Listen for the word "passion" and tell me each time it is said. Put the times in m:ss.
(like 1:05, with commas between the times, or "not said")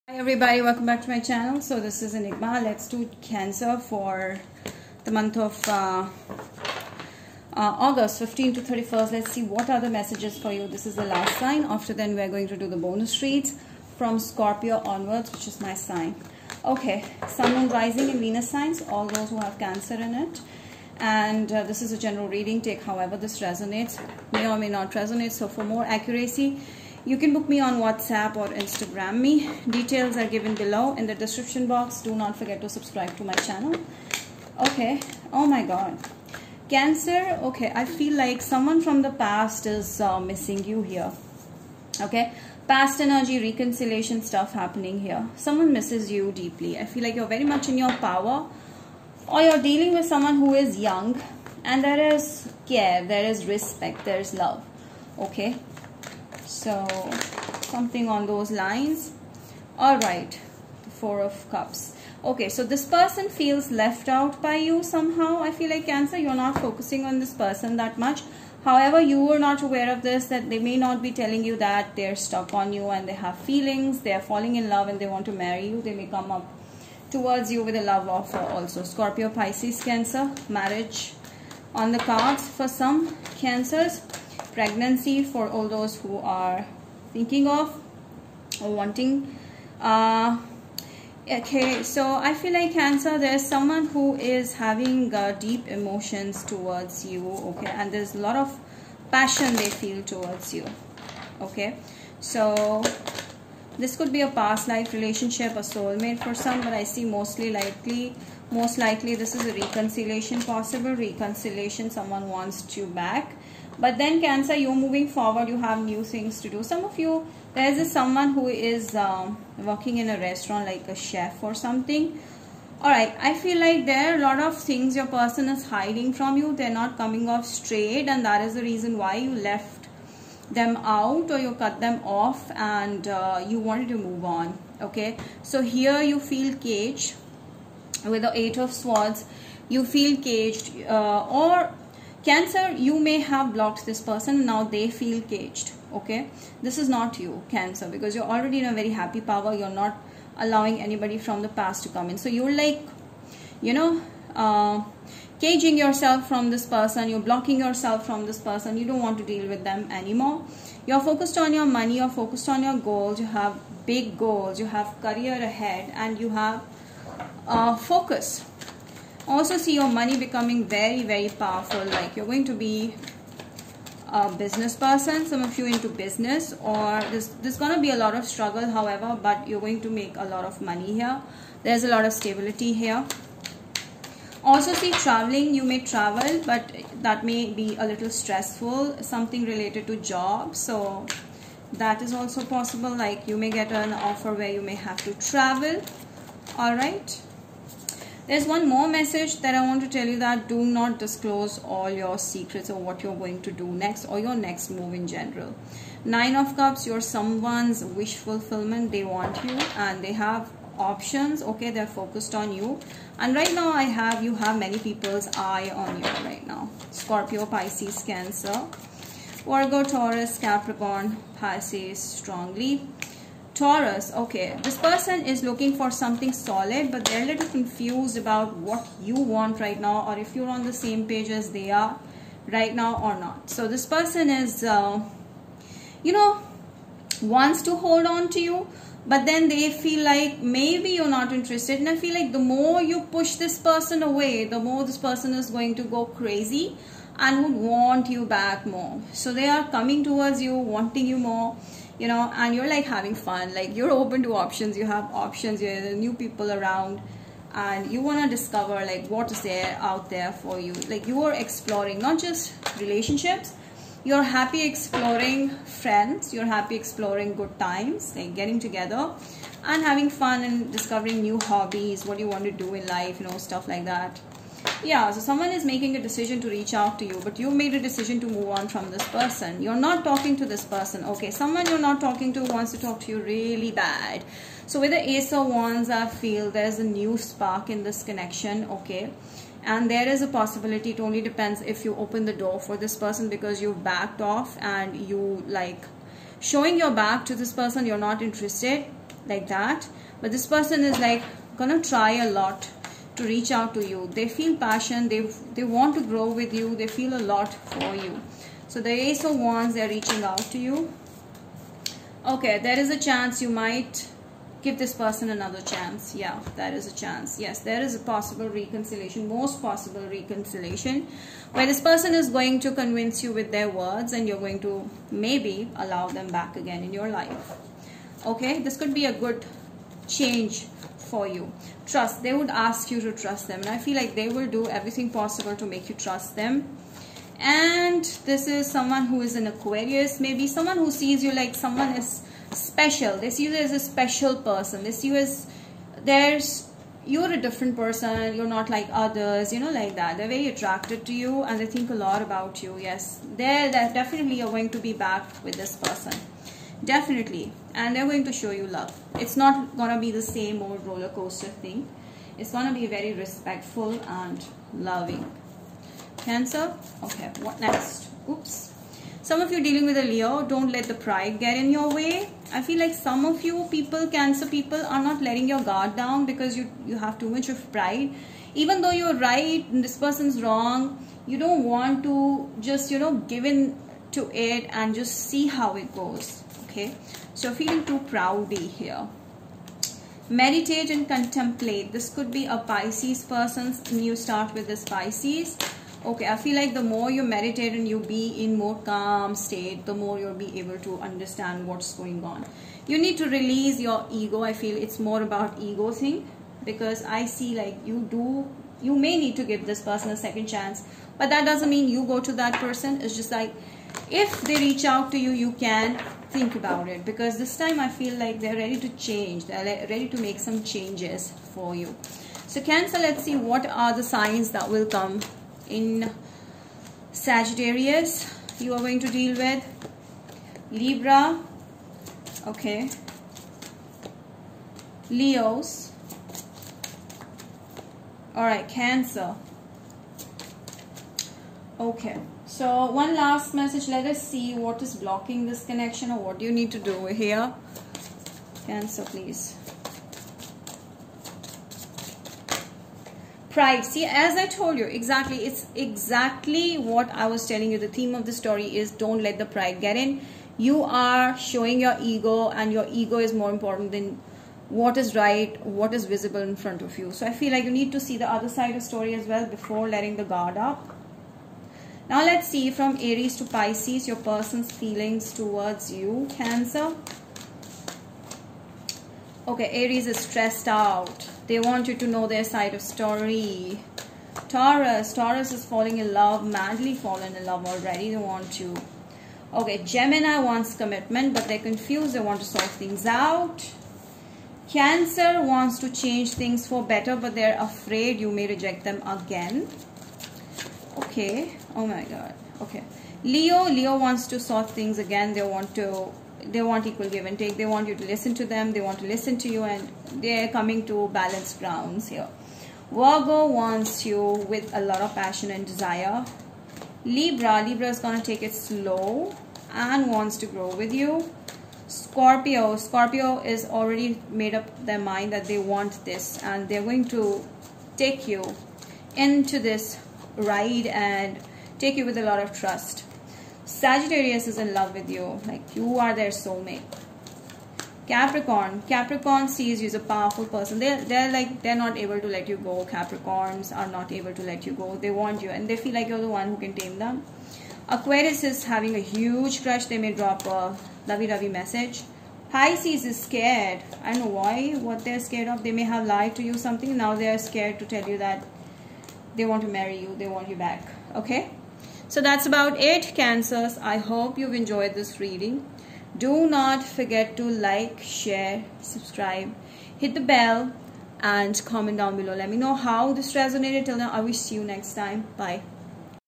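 1:39, 5:04, 8:35.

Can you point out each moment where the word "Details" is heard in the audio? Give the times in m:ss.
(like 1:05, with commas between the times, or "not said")
0:29.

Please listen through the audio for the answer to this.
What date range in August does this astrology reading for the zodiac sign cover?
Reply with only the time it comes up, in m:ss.
0:08.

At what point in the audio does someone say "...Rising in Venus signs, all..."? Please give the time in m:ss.
0:17.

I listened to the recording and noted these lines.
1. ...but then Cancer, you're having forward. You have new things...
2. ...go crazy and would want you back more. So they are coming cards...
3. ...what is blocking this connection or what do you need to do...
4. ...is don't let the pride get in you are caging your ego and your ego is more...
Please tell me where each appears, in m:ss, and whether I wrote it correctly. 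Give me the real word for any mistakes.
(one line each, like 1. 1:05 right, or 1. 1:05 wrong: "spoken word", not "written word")
1. 1:53 wrong: "moving", not "having"
2. 4:05 wrong: "towards", not "cards"
3. 7:24 right
4. 7:38 wrong: "showing", not "caging".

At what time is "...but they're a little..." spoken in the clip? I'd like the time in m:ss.
3:46.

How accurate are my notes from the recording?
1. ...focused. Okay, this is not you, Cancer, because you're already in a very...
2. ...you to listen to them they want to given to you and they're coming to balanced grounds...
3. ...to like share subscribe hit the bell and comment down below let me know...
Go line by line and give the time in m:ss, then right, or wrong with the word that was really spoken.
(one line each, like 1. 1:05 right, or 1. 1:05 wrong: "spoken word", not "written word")
1. 2:25 wrong: "caged", not "focused"
2. 8:27 wrong: "listen", not "given"
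3. 9:27 right.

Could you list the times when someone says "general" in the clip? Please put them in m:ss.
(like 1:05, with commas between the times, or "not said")
0:21, 3:25.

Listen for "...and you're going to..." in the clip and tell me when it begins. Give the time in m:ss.
5:24.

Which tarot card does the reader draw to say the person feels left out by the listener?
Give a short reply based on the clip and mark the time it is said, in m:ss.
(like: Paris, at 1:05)
Four of Cups, at 1:01.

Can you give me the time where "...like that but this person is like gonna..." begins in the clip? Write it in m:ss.
4:59.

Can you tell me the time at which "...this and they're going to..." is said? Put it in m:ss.
8:46.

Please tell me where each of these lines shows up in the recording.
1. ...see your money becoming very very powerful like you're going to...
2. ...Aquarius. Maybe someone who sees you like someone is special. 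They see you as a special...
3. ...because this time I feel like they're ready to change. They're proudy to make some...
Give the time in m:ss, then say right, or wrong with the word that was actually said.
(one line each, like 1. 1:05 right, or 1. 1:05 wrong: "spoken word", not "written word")
1. 2:49 right
2. 5:39 right
3. 6:57 wrong: "ready", not "proudy".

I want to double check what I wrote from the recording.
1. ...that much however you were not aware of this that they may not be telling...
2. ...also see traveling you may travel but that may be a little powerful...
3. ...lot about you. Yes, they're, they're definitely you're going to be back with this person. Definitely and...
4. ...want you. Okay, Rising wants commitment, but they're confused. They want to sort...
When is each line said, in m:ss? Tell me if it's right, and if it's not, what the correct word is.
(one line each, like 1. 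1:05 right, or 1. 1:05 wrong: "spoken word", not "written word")
1. 1:07 right
2. 3:04 wrong: "stressful", not "powerful"
3. 5:51 right
4. 8:08 wrong: "Gemini", not "Rising".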